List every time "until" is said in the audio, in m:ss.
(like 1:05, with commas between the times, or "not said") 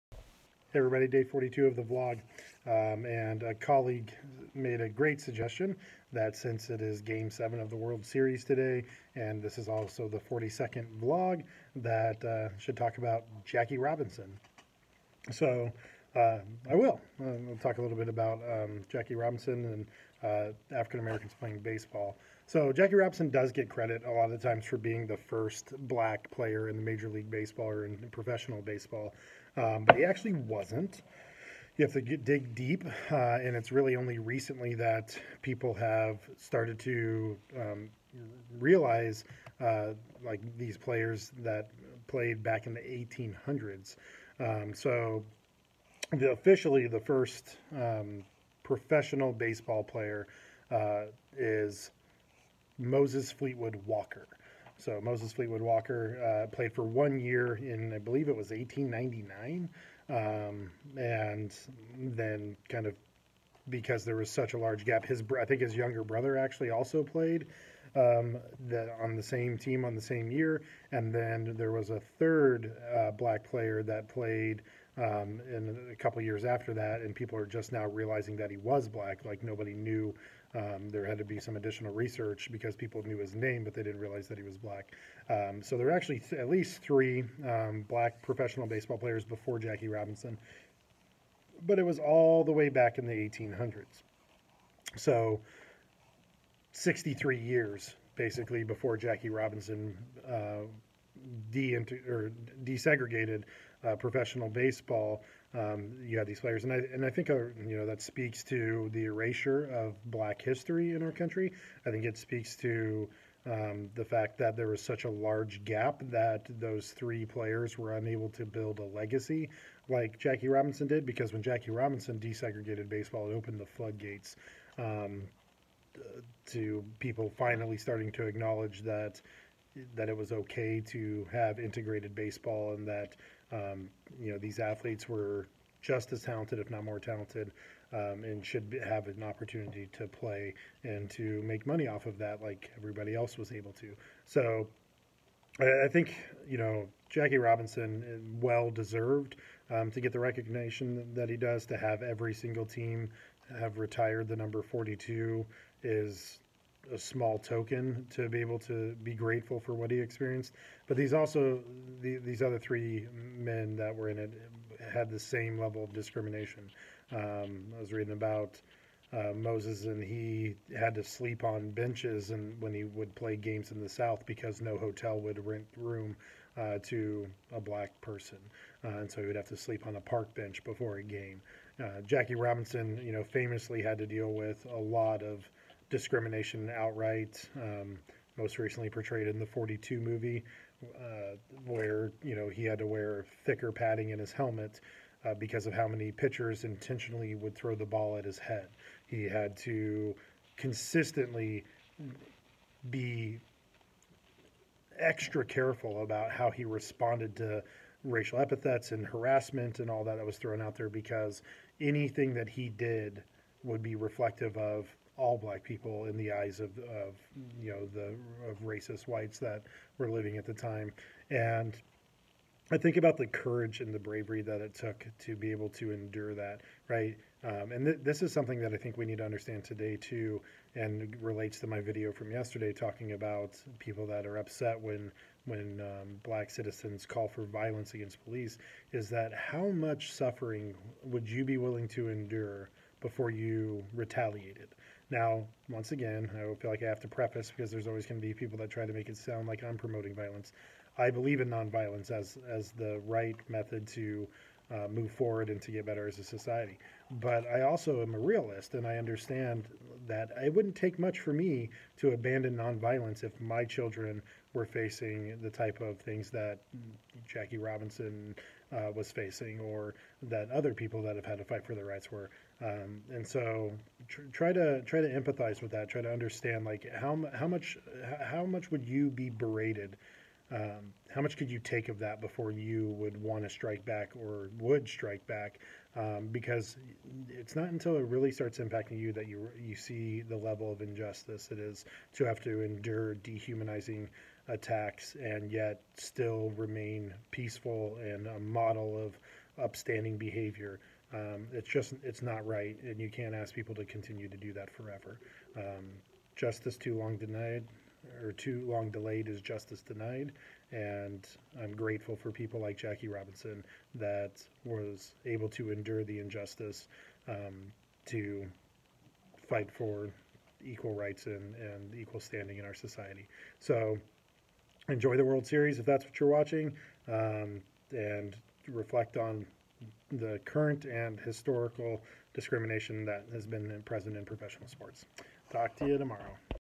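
4:47.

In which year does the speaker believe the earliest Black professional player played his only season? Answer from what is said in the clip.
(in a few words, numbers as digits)
1899.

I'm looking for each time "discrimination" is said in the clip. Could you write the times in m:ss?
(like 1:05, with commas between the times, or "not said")
2:45, 3:05, 5:32.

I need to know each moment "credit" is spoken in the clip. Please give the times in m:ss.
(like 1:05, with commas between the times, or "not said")
0:23.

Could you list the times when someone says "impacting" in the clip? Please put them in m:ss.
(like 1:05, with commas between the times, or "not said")
4:48.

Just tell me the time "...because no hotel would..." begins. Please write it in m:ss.
2:54.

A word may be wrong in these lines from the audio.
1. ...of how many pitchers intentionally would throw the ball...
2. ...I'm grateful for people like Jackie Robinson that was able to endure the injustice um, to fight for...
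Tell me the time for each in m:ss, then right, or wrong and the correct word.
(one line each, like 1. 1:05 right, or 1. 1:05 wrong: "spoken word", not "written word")
1. 3:15 right
2. 5:11 right.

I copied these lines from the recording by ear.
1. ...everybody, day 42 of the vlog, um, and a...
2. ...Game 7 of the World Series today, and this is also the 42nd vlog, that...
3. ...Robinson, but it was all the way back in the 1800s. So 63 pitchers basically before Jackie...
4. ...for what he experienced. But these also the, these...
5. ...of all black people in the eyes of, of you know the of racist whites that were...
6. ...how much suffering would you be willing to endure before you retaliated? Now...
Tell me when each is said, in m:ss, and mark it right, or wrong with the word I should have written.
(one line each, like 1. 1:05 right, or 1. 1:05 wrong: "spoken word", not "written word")
1. 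0:00 right
2. 0:07 right
3. 1:29 wrong: "years", not "pitchers"
4. 2:39 right
5. 3:34 right
6. 3:59 right.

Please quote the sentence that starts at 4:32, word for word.
Um, and so try to try to empathize with that.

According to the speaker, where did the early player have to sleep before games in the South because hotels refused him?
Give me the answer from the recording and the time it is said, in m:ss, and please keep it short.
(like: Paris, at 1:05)
a park bench, at 3:00.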